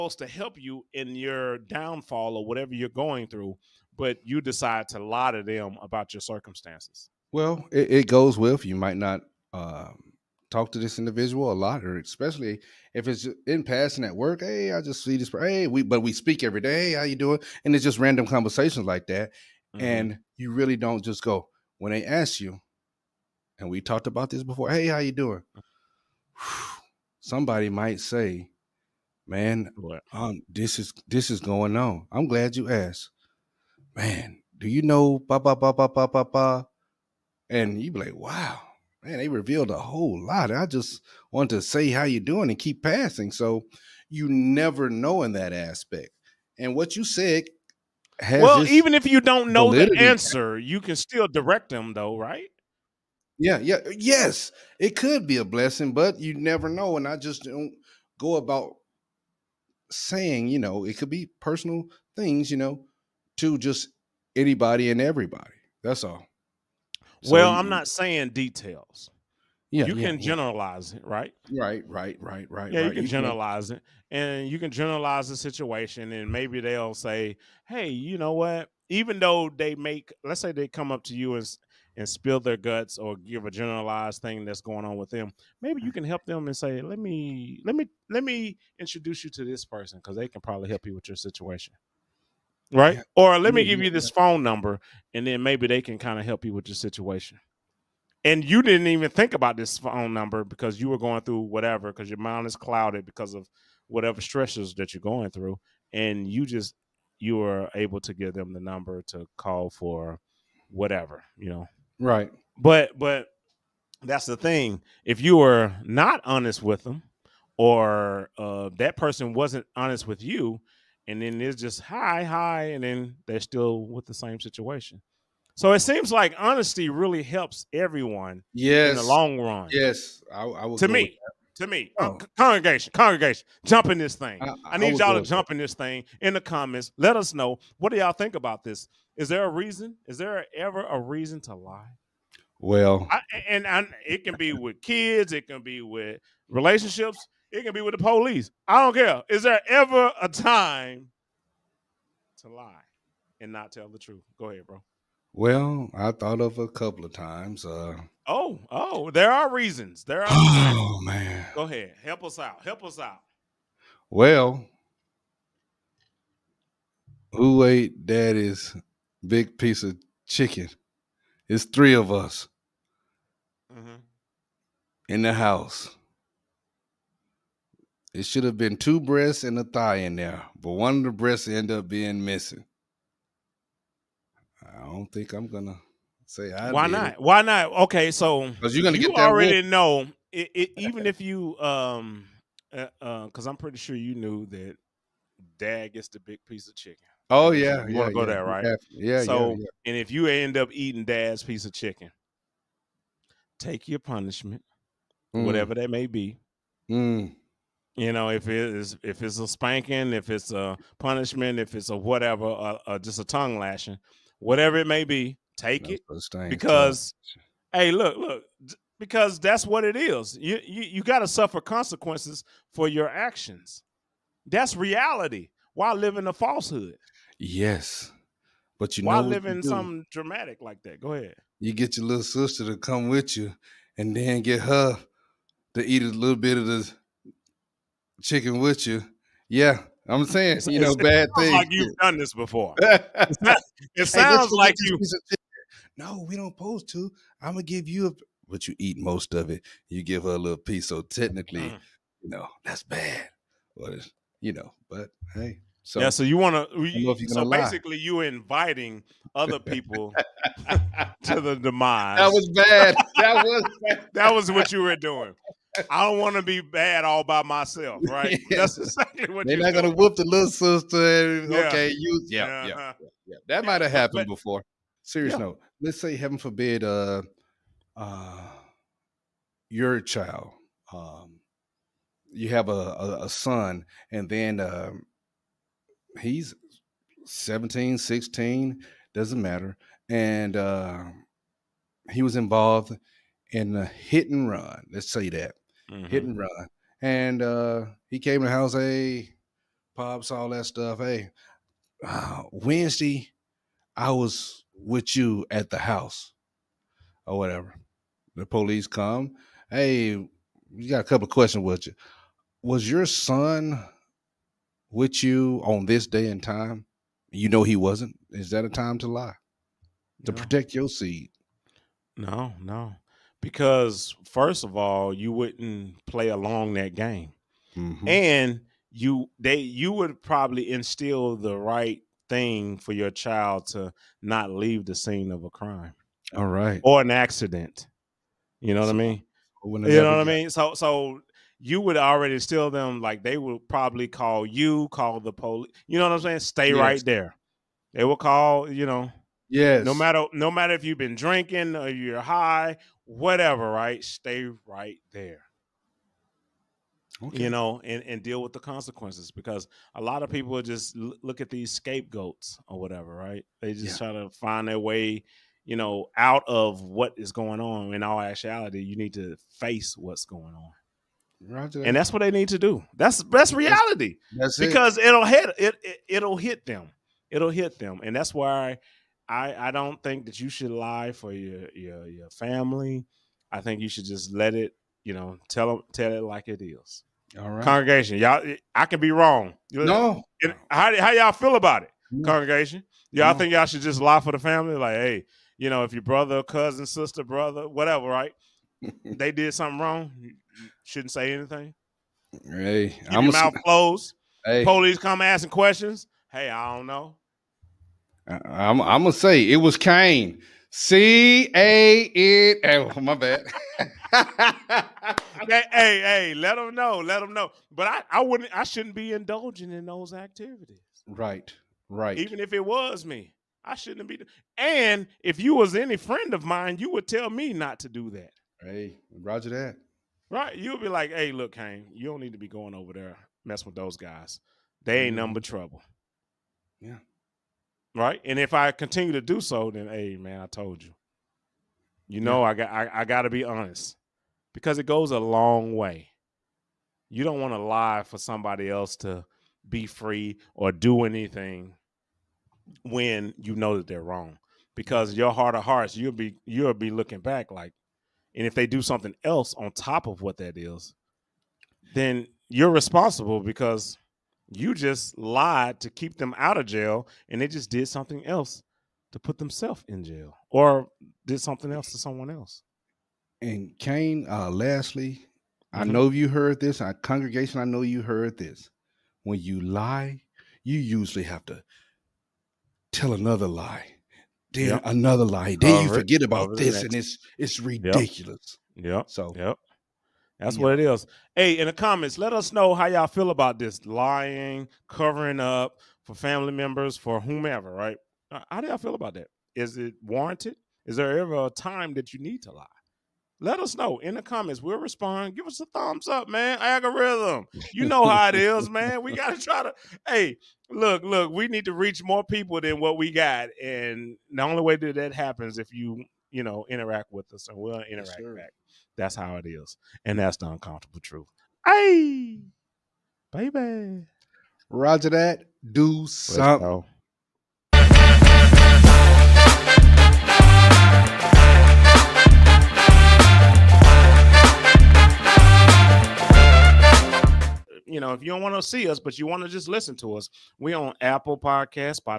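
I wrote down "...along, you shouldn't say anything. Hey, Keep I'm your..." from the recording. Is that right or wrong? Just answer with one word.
wrong.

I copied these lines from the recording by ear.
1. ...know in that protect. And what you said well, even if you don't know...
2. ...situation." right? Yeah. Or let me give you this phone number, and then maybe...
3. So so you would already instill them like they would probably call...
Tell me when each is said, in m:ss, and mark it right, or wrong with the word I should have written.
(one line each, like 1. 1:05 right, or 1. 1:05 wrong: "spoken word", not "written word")
1. 0:44 wrong: "aspect", not "protect"
2. 1:31 right
3. 5:40 right.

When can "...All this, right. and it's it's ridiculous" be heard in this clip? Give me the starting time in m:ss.
8:06.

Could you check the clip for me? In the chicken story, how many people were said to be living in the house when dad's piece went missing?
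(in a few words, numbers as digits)
3.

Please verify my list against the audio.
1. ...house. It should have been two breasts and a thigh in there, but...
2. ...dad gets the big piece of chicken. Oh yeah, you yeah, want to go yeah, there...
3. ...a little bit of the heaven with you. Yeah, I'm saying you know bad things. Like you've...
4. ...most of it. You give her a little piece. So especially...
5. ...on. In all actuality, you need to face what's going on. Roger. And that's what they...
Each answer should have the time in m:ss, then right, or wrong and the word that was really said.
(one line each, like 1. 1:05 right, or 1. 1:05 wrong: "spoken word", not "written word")
1. 2:55 right
2. 3:15 right
3. 3:56 wrong: "chicken", not "heaven"
4. 4:08 wrong: "technically", not "especially"
5. 6:07 right.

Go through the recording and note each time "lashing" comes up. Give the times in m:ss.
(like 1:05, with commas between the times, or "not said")
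3:33.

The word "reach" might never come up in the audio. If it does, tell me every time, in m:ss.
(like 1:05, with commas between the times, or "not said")
8:31.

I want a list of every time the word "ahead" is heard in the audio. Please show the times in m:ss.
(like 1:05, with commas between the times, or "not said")
2:34, 2:41, 3:51.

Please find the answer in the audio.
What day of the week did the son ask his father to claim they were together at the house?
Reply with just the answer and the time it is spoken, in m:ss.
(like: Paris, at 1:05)
Wednesday, at 5:02.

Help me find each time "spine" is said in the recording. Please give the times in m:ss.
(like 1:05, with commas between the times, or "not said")
not said.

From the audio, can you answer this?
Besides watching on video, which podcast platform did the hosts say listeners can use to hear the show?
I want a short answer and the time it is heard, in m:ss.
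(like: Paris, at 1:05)
Apple Podcast, at 9:01.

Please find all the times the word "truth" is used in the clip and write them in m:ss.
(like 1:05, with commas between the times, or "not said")
2:33, 8:41.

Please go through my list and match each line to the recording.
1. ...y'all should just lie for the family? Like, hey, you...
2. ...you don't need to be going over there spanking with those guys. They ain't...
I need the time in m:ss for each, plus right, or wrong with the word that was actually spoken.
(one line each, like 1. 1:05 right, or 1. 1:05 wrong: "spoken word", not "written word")
1. 6:33 right
2. 7:11 wrong: "messing", not "spanking".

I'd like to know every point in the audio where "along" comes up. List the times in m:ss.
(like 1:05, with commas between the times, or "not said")
5:26.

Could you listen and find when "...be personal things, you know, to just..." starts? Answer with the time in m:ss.
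1:01.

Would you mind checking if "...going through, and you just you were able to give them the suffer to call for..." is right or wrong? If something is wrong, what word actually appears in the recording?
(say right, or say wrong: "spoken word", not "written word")
wrong: "number", not "suffer".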